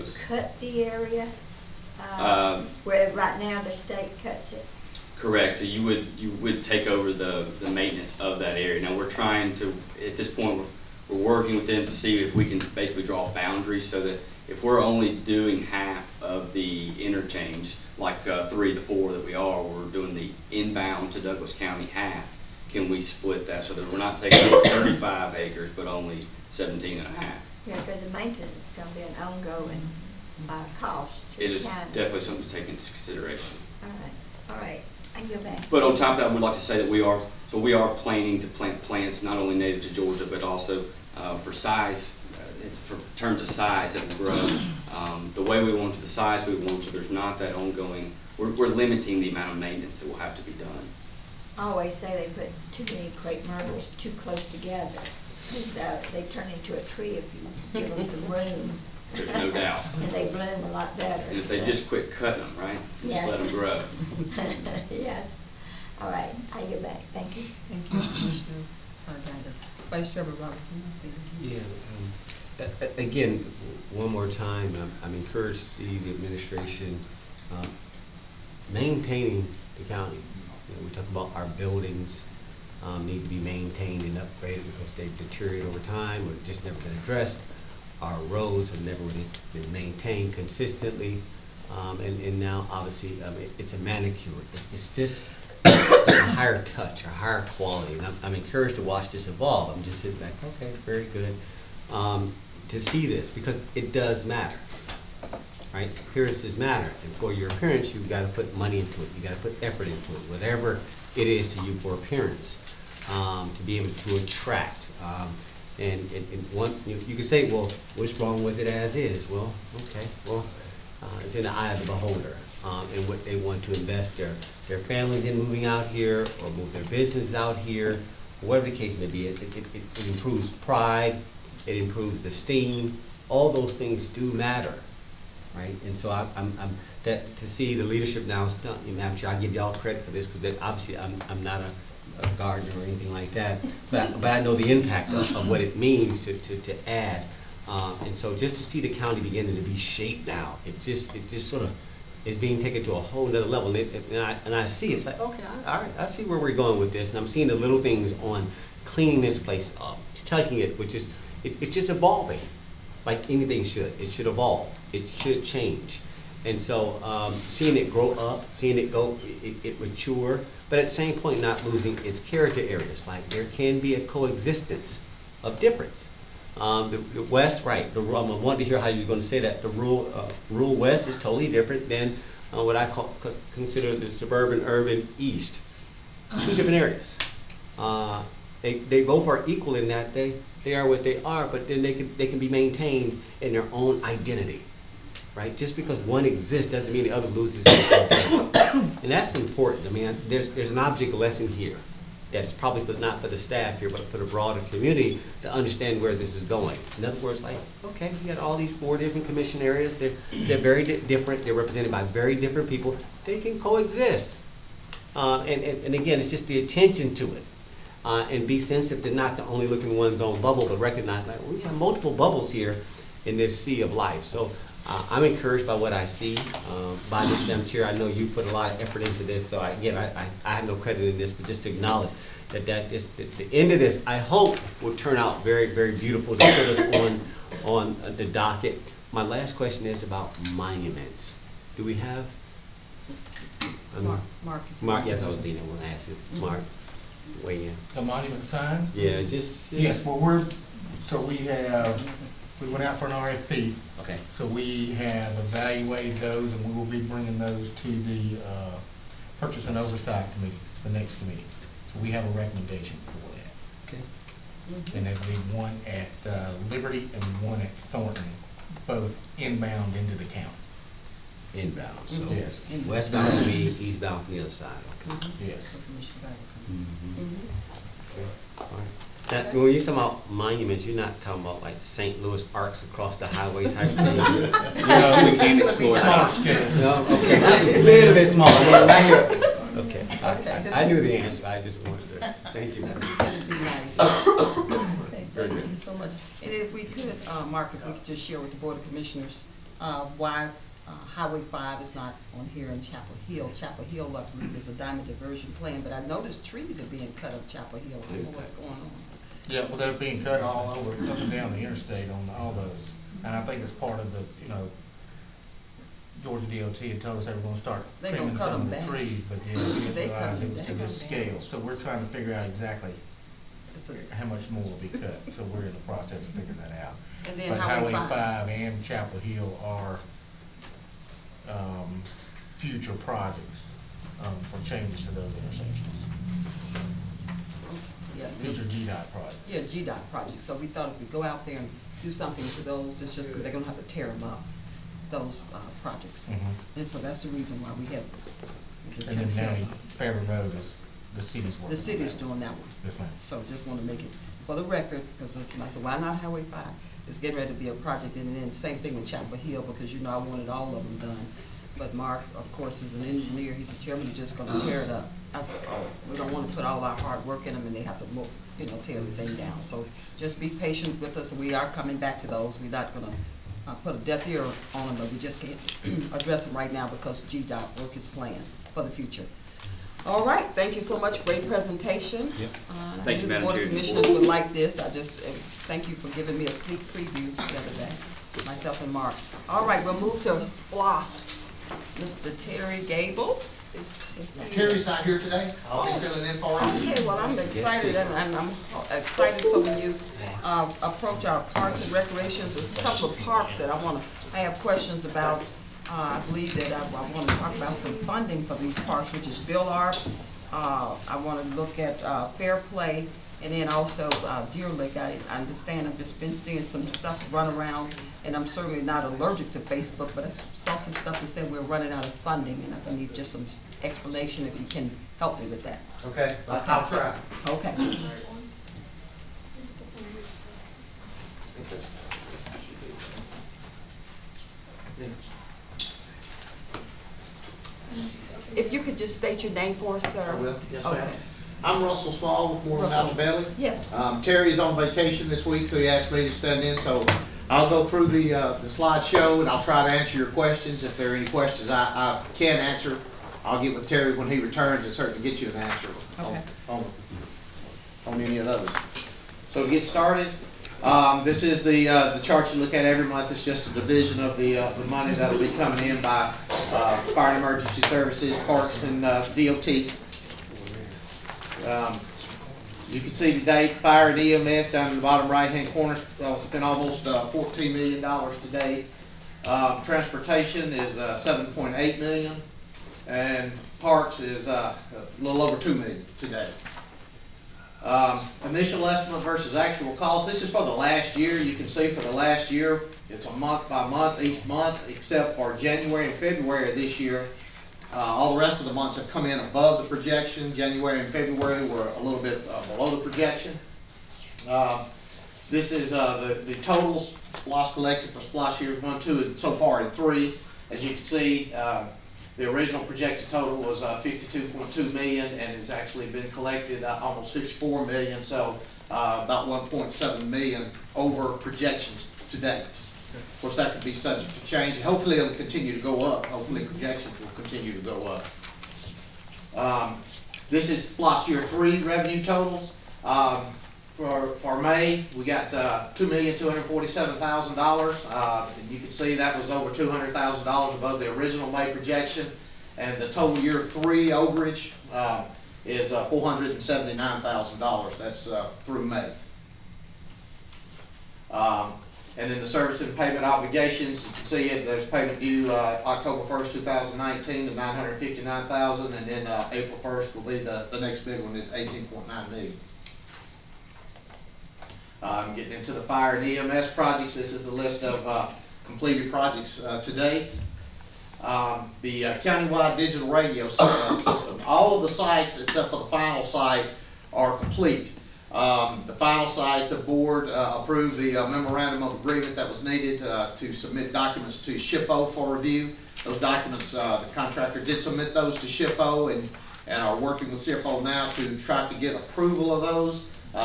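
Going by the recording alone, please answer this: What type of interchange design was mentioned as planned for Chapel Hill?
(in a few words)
Diamond diversion.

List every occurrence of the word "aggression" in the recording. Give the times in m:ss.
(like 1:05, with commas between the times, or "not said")
not said.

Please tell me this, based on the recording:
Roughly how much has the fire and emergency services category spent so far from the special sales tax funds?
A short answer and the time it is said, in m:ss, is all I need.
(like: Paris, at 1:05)
$14 million, at 7:57.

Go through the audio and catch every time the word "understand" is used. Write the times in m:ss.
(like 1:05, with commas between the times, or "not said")
3:25, 6:55.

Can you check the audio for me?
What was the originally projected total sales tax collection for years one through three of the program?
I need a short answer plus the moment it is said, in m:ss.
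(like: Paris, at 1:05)
52.2 million, at 8:34.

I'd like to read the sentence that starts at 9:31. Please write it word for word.
Um, the uh, countywide digital radio system, all of the sites except for the final site are complete.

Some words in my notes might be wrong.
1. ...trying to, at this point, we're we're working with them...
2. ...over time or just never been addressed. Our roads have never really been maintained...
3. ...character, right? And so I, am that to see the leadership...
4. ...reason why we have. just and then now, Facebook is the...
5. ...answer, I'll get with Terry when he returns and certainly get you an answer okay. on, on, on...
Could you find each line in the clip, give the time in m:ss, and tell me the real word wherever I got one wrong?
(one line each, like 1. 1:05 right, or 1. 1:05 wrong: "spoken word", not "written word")
1. 0:09 right
2. 1:25 right
3. 2:14 wrong: "matter", not "character"
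4. 5:47 wrong: "Road", not "Facebook"
5. 7:32 right.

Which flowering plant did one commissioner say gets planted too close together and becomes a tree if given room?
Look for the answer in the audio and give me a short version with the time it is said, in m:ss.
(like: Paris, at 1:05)
Crepe myrtles, at 0:53.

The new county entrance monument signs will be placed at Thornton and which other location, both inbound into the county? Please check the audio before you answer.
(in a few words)
Liberty.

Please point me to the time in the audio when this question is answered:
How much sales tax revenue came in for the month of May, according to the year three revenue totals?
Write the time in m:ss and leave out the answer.
8:55.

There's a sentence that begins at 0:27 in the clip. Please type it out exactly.
Yeah, because the maintenance is going to be an ongoing uh, cost.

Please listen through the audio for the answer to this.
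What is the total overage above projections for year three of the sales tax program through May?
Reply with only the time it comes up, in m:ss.
9:06.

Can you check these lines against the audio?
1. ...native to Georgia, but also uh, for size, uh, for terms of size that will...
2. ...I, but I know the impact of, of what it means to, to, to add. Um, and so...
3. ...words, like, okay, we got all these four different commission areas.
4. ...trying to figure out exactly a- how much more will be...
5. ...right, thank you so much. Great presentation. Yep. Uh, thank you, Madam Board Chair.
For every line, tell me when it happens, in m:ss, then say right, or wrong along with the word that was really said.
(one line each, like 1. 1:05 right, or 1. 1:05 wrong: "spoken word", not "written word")
1. 0:39 right
2. 2:24 right
3. 3:27 right
4. 5:21 right
5. 6:20 right.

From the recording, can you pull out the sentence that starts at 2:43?
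It should evolve, it should change.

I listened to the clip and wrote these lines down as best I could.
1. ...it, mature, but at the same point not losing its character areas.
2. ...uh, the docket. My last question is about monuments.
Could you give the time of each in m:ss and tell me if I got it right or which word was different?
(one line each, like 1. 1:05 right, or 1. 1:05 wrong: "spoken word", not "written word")
1. 2:49 right
2. 3:58 right.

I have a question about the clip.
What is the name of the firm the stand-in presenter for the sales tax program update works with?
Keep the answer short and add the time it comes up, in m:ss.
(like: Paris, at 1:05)
Moreland Altobelli, at 7:22.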